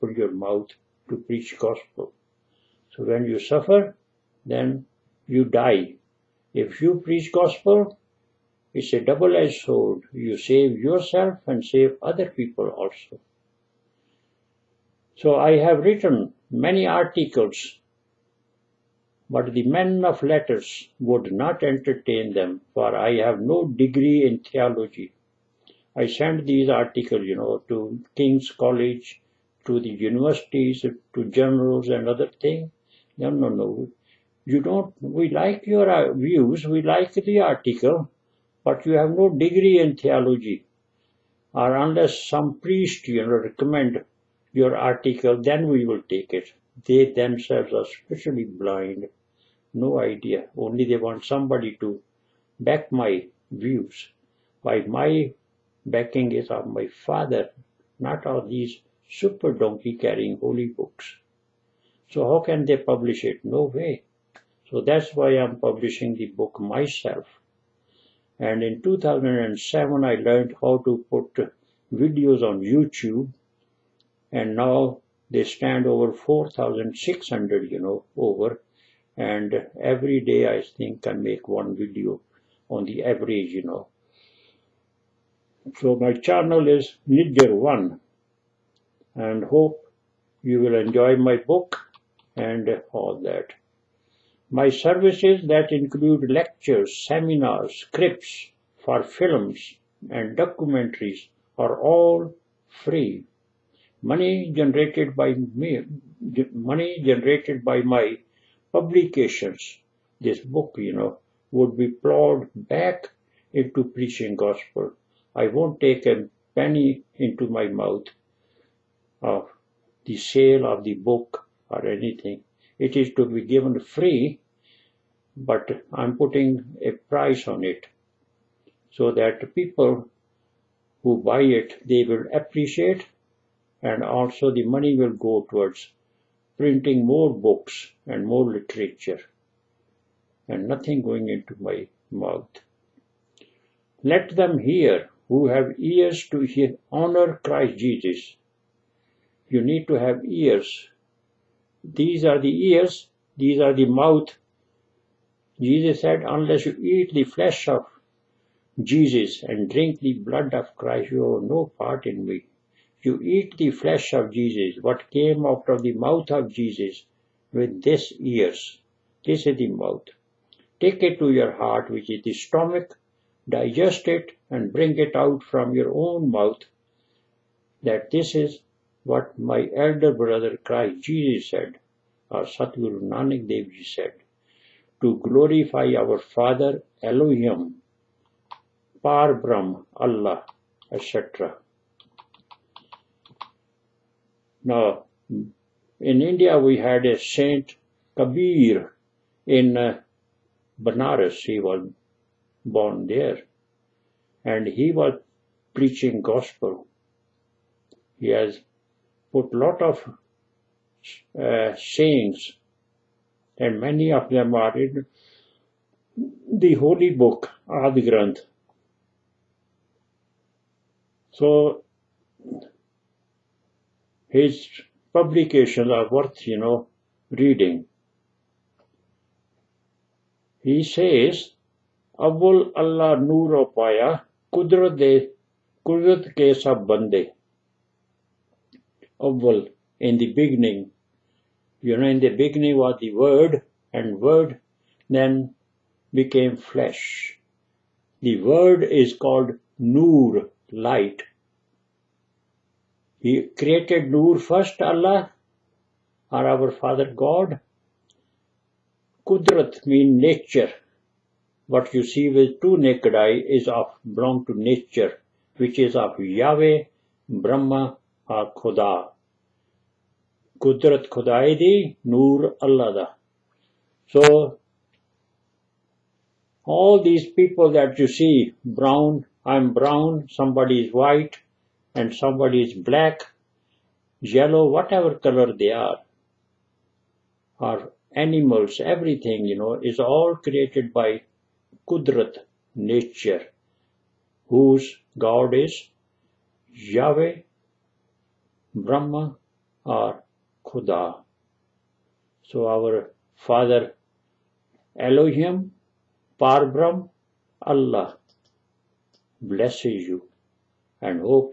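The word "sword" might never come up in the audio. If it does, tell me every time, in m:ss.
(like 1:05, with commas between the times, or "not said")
0:09.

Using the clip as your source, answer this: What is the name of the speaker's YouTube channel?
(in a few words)
Nijjhar One.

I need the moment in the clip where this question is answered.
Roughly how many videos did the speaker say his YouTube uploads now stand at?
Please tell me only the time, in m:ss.
1:16.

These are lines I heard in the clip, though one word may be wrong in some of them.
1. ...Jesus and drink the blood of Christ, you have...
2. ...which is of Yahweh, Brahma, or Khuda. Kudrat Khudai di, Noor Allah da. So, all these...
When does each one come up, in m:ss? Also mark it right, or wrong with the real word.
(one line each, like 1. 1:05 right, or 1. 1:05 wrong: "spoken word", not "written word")
1. 2:38 right
2. 4:25 right.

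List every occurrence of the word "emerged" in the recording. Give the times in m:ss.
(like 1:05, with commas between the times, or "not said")
not said.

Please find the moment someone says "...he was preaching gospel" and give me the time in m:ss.
3:24.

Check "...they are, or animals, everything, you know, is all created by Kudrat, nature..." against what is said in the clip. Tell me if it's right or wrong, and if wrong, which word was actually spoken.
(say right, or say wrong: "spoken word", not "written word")
right.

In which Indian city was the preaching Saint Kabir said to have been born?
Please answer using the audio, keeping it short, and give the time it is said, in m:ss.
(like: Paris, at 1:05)
Banaras, at 3:20.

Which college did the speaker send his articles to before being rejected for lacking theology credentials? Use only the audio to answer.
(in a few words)
King's College.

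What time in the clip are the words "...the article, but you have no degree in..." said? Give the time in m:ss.
0:37.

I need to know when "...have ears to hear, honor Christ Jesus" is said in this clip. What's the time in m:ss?
2:25.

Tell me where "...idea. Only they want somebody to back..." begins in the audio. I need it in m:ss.
0:49.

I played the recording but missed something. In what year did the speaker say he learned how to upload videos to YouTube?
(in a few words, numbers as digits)
2007.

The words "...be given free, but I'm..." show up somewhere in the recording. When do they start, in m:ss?
2:03.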